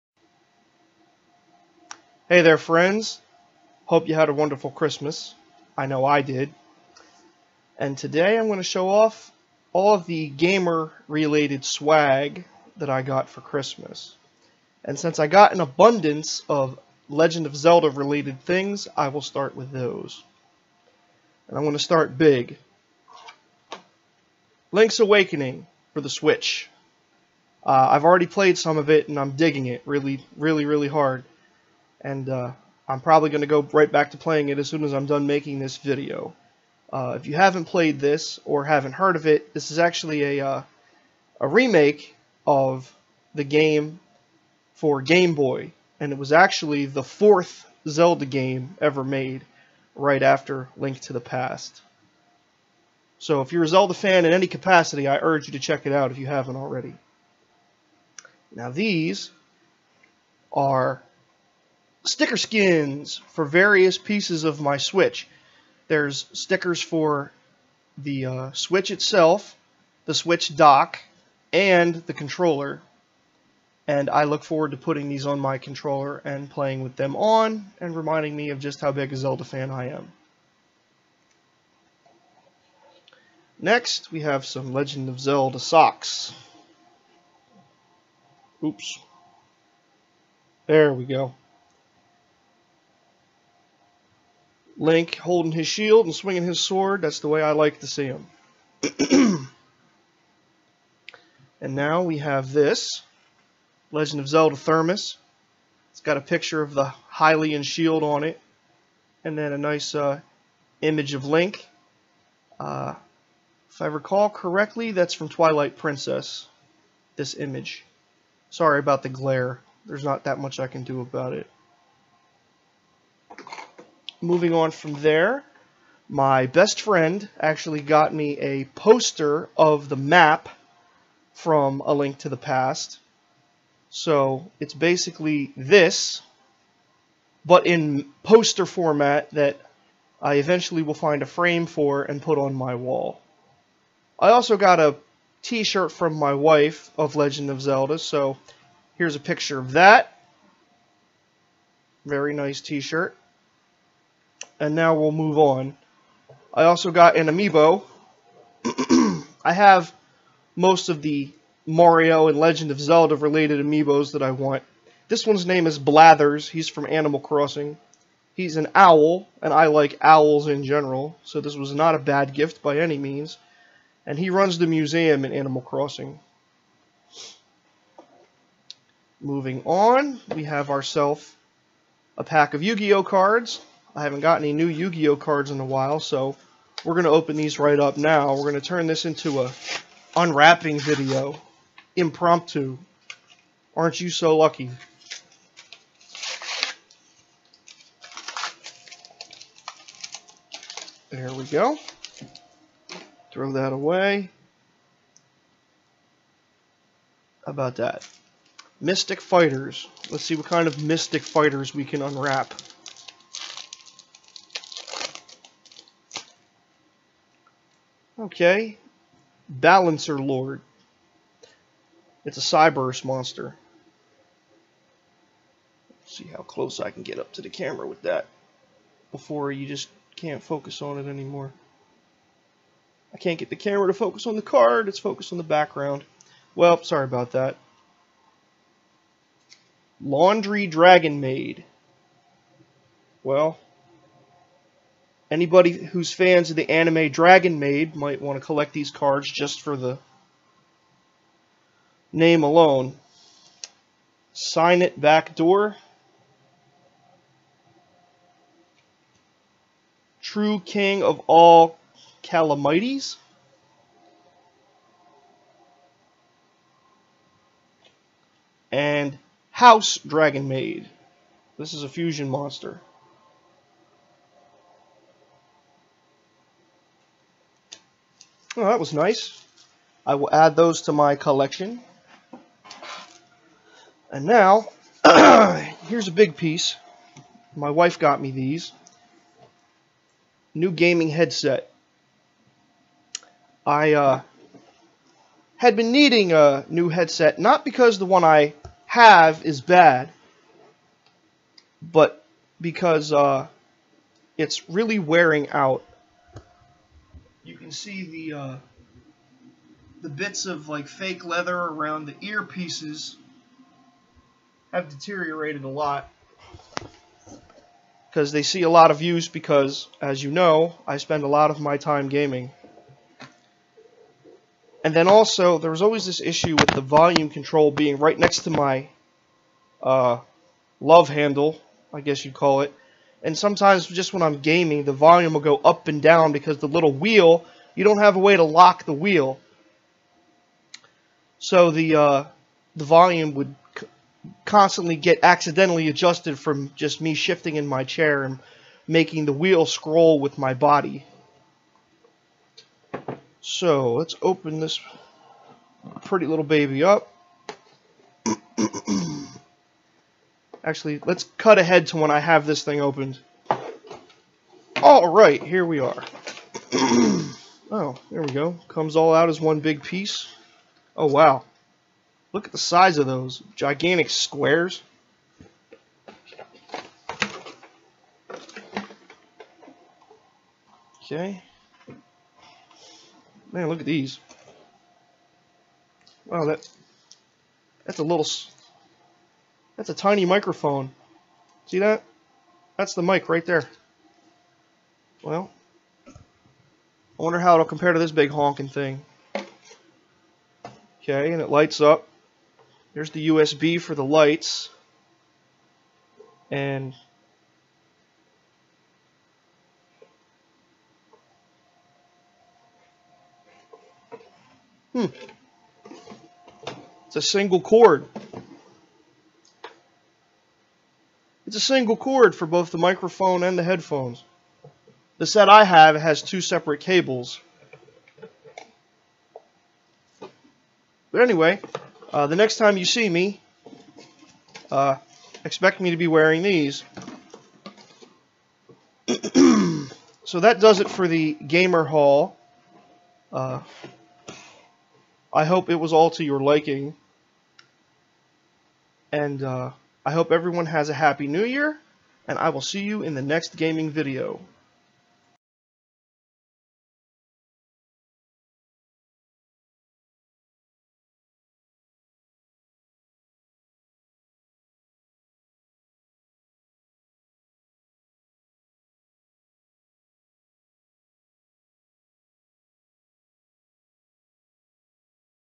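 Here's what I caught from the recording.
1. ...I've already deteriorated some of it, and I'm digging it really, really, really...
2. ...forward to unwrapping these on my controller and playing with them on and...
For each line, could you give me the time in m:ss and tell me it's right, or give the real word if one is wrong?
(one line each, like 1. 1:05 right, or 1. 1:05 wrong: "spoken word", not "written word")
1. 0:27 wrong: "played", not "deteriorated"
2. 1:14 wrong: "putting", not "unwrapping".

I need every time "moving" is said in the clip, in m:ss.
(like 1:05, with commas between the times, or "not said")
2:04, 2:59.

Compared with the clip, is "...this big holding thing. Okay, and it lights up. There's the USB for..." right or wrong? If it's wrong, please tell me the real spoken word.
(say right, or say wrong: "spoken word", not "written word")
wrong: "honking", not "holding".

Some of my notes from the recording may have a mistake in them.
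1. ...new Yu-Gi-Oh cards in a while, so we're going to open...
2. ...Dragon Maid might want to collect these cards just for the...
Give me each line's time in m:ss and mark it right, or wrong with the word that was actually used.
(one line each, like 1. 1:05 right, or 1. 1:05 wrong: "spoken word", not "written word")
1. 3:04 right
2. 4:07 right.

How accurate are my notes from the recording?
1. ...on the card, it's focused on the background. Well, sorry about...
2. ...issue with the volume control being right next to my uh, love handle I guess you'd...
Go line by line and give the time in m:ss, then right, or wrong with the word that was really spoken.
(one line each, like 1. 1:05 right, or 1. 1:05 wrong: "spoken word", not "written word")
1. 3:54 right
2. 5:26 right.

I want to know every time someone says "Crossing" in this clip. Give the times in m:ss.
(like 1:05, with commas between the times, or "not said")
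2:47, 2:55.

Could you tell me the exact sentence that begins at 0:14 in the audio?
And since I got an abundance of Legend of Zelda-related things, I will start with those.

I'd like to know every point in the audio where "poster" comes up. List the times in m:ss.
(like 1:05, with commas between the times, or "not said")
2:08, 2:18.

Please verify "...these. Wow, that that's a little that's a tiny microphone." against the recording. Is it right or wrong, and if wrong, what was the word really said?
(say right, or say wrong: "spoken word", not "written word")
right.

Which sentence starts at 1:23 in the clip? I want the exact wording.
Next, we have some Legend of Zelda socks.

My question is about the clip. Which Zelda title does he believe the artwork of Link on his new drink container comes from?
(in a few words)
Twilight Princess.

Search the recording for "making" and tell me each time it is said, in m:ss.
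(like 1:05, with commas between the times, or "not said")
0:35, 5:48.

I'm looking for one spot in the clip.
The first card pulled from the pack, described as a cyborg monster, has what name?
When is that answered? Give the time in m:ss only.
3:39.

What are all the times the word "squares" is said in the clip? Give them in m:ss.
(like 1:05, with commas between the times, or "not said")
6:14.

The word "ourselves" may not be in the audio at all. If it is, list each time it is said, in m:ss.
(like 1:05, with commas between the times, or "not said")
3:00.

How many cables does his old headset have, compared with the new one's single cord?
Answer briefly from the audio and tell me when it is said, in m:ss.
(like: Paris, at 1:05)
2, at 7:06.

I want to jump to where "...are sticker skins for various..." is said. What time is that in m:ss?
1:00.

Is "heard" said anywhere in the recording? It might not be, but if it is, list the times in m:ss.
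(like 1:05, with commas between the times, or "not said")
0:38.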